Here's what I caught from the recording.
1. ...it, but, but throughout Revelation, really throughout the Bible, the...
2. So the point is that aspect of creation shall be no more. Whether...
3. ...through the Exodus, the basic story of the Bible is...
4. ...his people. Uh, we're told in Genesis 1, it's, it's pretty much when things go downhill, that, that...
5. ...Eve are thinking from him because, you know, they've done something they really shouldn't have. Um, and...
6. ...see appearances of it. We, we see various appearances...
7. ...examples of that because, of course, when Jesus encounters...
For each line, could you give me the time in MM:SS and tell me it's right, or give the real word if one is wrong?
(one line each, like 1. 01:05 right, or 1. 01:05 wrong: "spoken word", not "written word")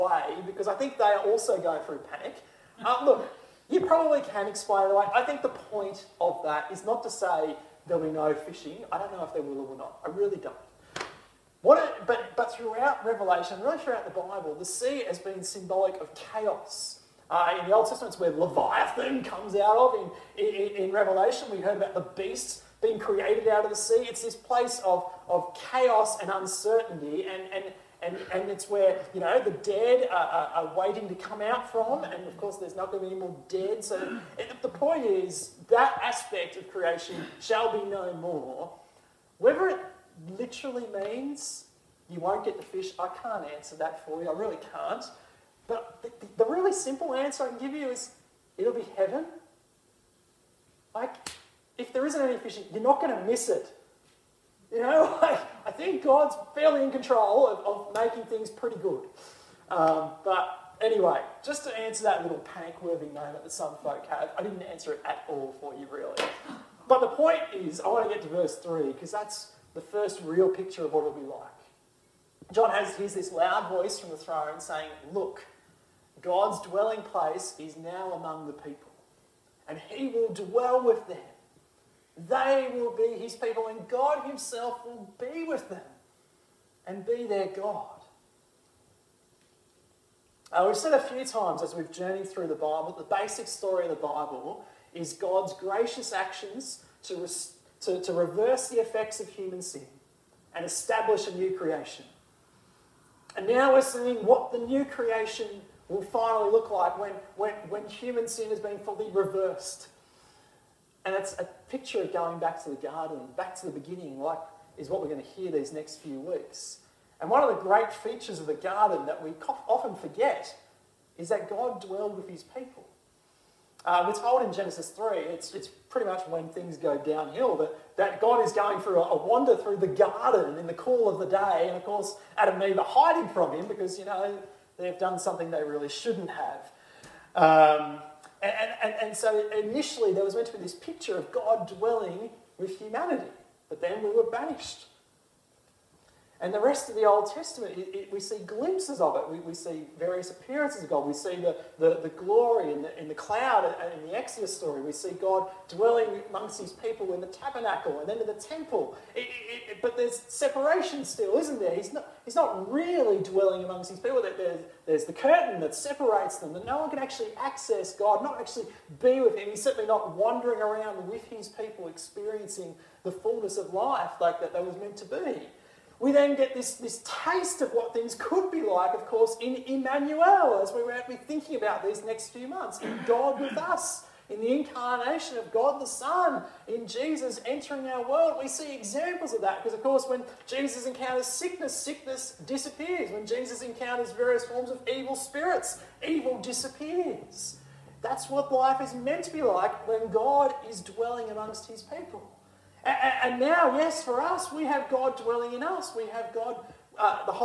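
1. 00:11 right
2. 00:33 right
3. 01:32 wrong: "Bible", not "Exodus"
4. 02:02 wrong: "3", not "1"
5. 02:12 wrong: "hiding", not "thinking"
6. 02:28 wrong: "glimpses", not "appearances"
7. 03:08 right.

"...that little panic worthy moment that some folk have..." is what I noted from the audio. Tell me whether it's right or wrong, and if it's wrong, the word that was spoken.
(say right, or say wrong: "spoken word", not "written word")
right.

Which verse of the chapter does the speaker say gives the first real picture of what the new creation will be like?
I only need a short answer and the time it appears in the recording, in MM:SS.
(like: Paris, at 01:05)
Verse 3, at 01:08.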